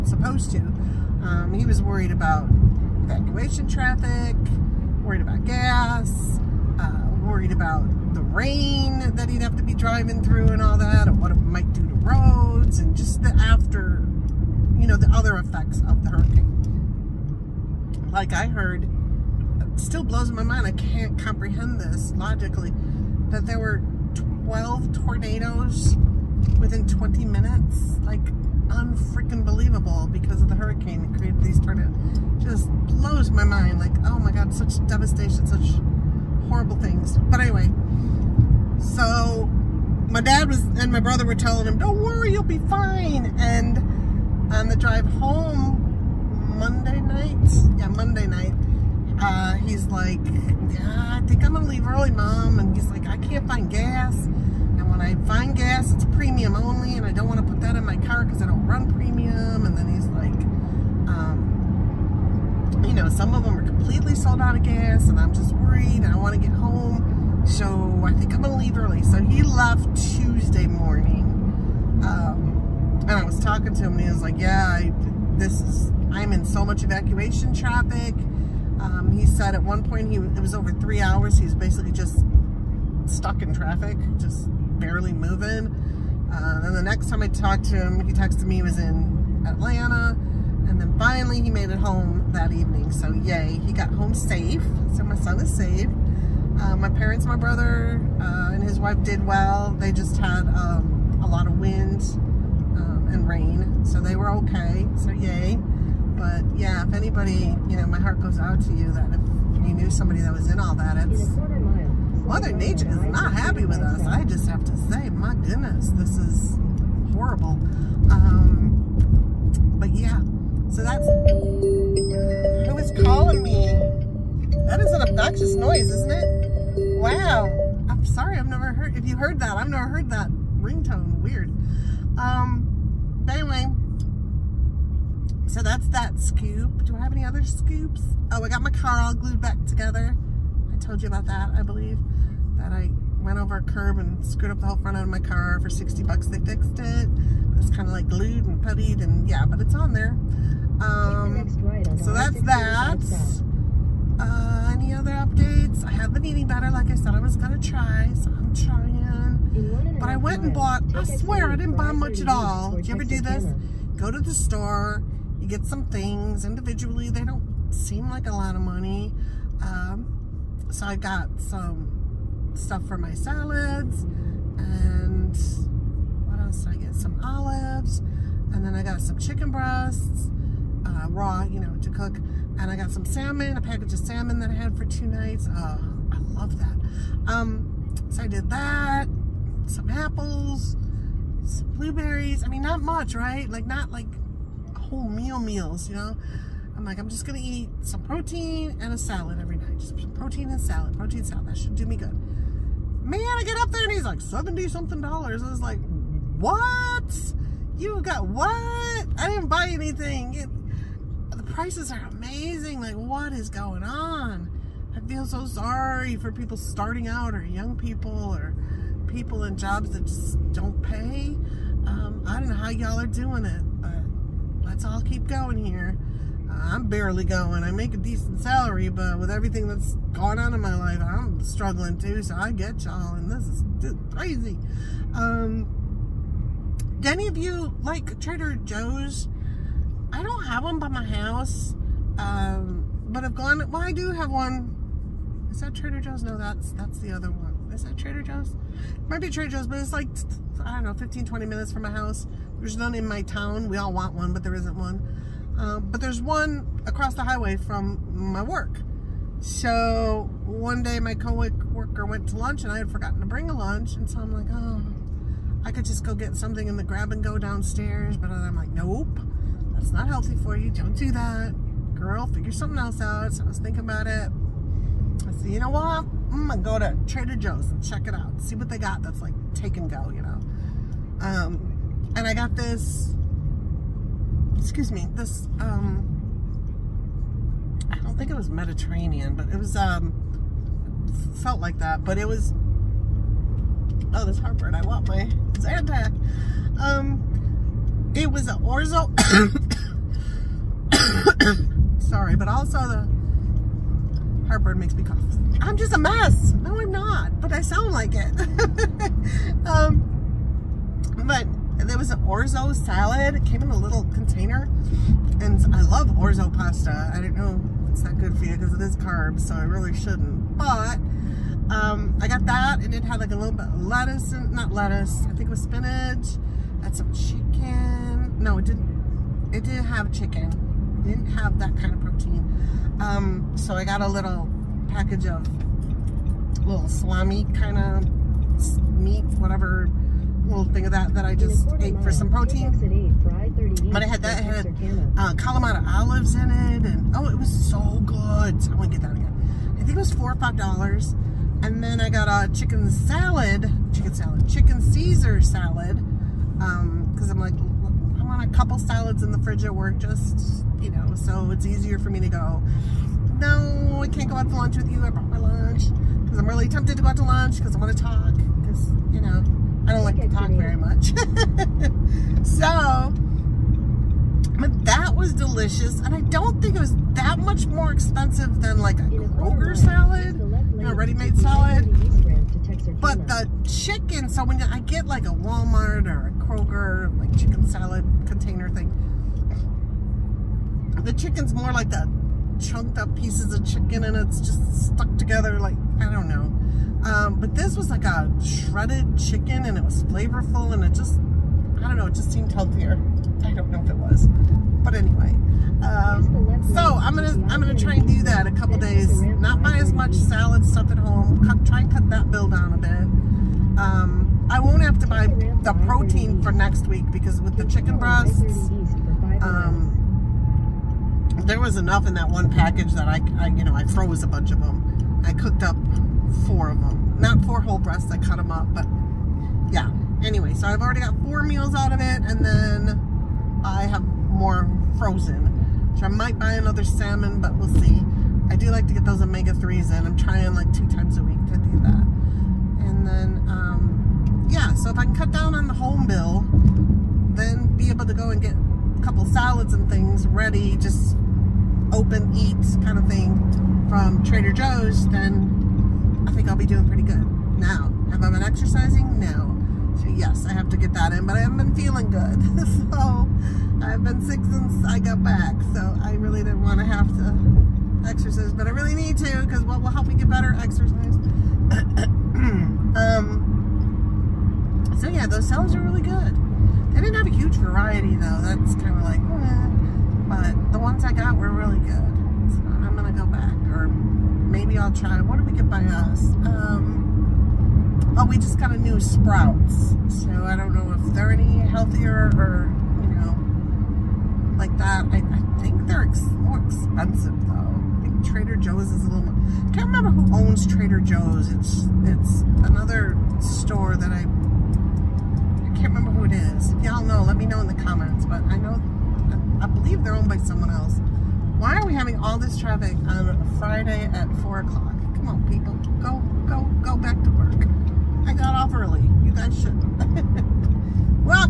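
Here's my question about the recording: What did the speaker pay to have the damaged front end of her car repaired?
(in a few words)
$60.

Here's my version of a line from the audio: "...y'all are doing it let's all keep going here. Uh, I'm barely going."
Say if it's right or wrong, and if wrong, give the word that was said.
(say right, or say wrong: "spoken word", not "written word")
right.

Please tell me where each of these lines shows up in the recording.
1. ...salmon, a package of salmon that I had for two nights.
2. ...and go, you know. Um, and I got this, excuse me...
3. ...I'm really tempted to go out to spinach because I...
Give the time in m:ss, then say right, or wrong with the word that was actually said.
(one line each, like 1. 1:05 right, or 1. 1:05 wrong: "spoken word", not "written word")
1. 3:03 right
2. 4:39 right
3. 6:06 wrong: "lunch", not "spinach".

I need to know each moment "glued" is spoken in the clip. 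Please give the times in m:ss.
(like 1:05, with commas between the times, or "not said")
2:19, 2:28.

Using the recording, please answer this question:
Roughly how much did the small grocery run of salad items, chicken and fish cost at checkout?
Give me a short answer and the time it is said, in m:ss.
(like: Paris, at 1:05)
70 something dollars, at 3:24.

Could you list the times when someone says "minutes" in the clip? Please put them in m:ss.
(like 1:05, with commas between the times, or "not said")
0:27, 4:11.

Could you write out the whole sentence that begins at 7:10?
Anyway, so I've already got four meals out of it, and then I have more frozen.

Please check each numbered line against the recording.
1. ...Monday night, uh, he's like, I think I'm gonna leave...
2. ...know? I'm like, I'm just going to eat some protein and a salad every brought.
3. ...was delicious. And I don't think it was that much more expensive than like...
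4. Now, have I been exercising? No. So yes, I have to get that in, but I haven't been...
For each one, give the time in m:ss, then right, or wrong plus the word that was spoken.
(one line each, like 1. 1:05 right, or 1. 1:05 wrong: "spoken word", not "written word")
1. 0:47 right
2. 3:15 wrong: "night", not "brought"
3. 6:15 right
4. 7:37 right.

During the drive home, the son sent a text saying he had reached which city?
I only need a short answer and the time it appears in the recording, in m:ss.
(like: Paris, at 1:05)
Atlanta, at 1:29.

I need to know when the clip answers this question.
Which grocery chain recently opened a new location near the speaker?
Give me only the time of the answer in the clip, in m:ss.
8:08.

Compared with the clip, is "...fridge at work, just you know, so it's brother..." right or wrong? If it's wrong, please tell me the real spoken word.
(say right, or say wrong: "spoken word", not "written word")
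wrong: "easier", not "brother".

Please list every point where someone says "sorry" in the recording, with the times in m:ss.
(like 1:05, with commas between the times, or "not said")
2:08, 3:35, 5:02.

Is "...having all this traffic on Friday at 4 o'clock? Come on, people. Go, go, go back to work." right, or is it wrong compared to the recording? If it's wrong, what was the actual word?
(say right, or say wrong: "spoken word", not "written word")
right.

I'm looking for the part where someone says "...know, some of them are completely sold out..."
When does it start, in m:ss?
1:02.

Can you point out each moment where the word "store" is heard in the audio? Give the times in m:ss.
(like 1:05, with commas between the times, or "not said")
2:44, 8:23.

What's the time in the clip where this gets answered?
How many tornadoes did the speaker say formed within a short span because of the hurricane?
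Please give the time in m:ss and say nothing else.
0:24.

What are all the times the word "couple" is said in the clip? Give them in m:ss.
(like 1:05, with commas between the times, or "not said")
5:58, 6:48, 7:29.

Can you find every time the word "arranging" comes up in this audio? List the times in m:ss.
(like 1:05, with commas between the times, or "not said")
not said.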